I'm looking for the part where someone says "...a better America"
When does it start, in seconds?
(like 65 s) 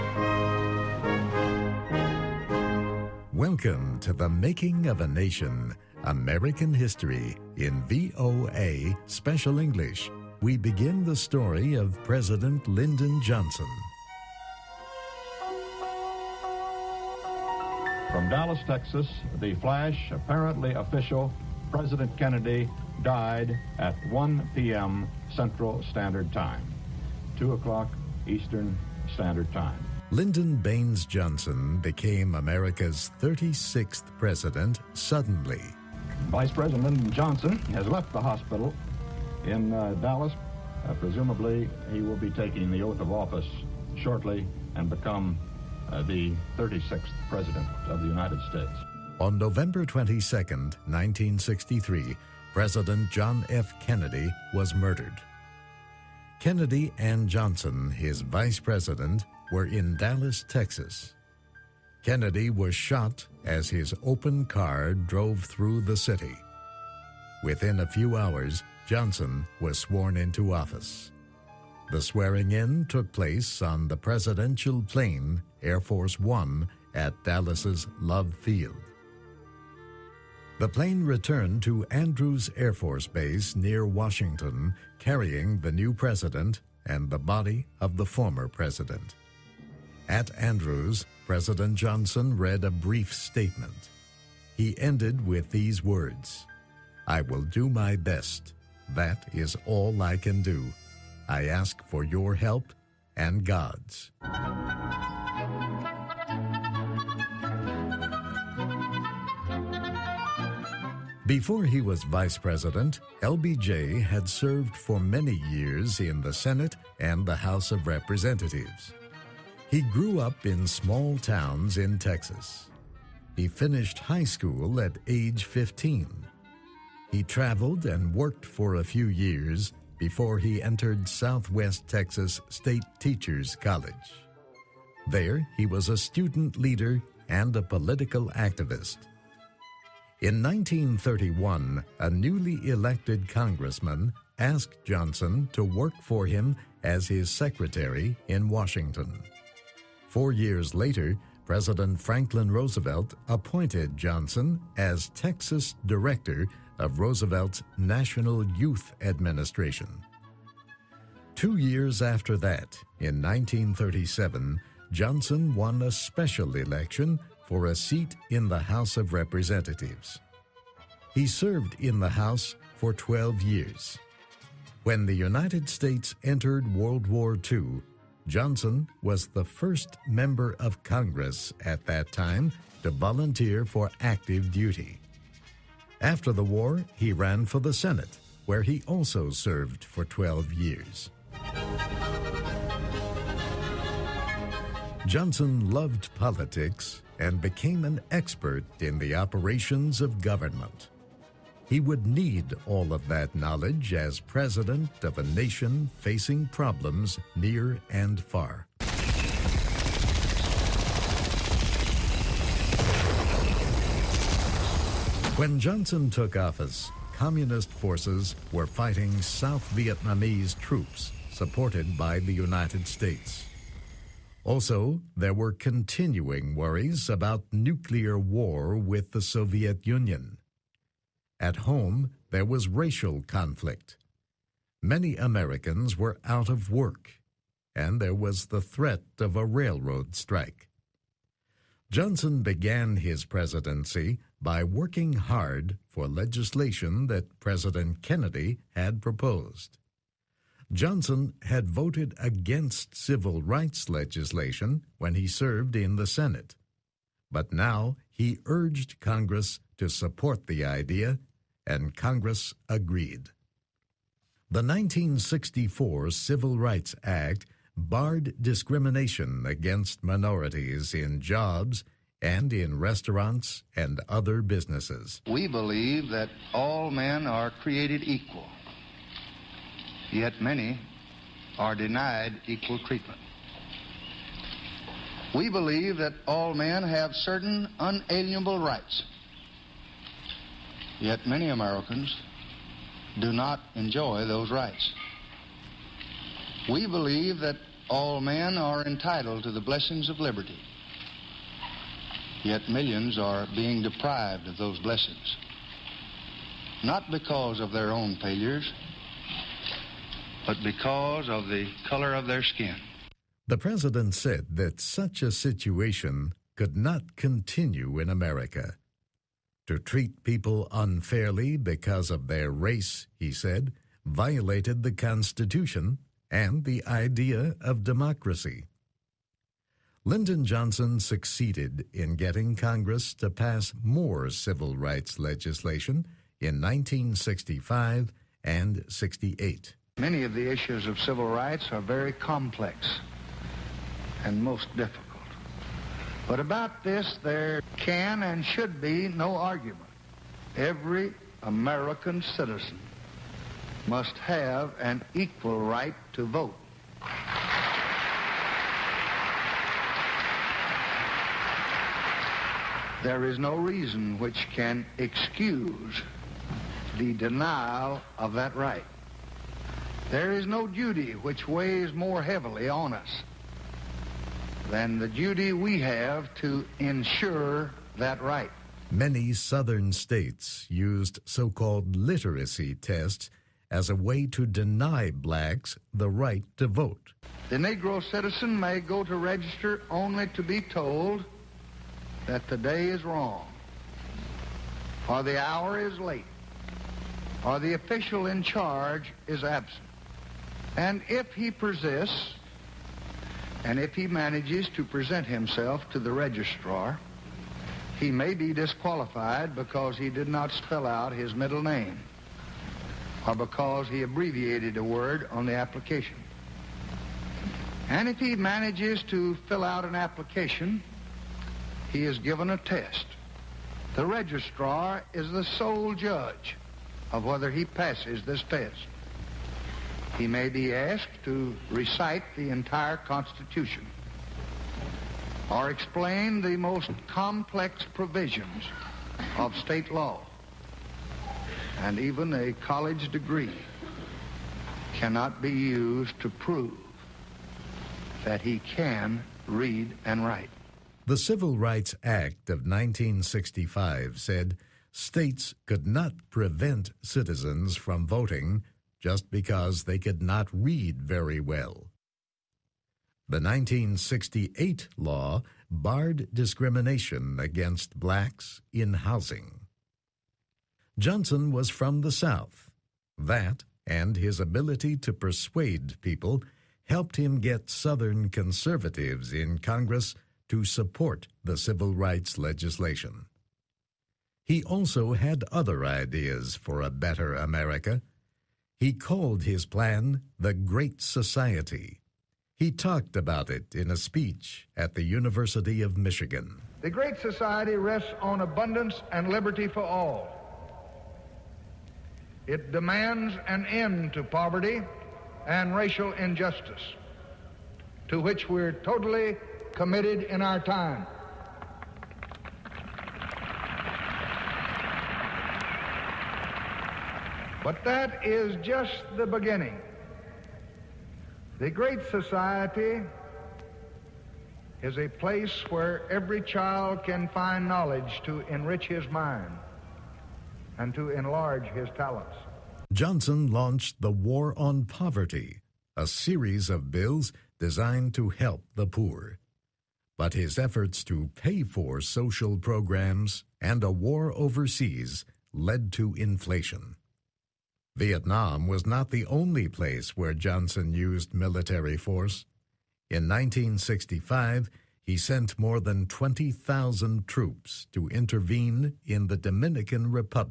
486 s.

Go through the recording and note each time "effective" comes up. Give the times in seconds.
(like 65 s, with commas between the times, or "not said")
not said.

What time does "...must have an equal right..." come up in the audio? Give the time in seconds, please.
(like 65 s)
353 s.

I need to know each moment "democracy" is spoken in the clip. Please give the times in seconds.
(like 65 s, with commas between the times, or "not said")
327 s.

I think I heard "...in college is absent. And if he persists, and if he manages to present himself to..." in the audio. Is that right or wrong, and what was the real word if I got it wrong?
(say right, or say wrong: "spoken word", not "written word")
wrong: "charge", not "college".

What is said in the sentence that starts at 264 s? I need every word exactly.
The 1964 Civil Rights Act barred discrimination against minorities in jobs and in restaurants and other businesses.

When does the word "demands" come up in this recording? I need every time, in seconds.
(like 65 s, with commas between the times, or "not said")
502 s.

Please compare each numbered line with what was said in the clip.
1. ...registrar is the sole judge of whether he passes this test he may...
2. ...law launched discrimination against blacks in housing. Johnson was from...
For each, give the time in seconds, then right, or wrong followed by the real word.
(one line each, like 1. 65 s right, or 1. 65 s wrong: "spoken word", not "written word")
1. 424 s right
2. 464 s wrong: "barred", not "launched".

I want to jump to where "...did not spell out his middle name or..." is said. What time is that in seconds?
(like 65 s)
410 s.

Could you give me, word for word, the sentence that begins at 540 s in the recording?
But his efforts to pay for social programs and a war overseas led to inflation.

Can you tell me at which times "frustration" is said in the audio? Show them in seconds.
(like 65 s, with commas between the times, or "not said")
not said.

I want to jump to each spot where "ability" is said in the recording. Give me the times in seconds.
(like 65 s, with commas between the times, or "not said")
474 s.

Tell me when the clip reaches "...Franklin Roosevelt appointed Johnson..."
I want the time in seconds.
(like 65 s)
152 s.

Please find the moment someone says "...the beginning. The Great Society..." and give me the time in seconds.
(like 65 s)
519 s.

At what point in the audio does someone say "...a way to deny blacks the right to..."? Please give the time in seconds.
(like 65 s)
383 s.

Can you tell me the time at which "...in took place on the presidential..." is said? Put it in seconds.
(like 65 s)
72 s.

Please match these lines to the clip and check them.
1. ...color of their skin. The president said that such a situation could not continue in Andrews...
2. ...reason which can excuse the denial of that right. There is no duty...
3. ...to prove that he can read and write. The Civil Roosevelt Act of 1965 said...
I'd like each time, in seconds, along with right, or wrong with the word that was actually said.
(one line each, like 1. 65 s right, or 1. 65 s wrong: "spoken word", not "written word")
1. 311 s wrong: "America", not "Andrews"
2. 363 s right
3. 446 s wrong: "Rights", not "Roosevelt".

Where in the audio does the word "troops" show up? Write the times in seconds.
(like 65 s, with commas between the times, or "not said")
220 s, 557 s.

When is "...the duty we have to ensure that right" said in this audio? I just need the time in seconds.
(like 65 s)
374 s.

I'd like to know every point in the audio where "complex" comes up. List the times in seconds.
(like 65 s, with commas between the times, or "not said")
342 s, 437 s.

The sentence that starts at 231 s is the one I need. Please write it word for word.
At home, there was racial conflict.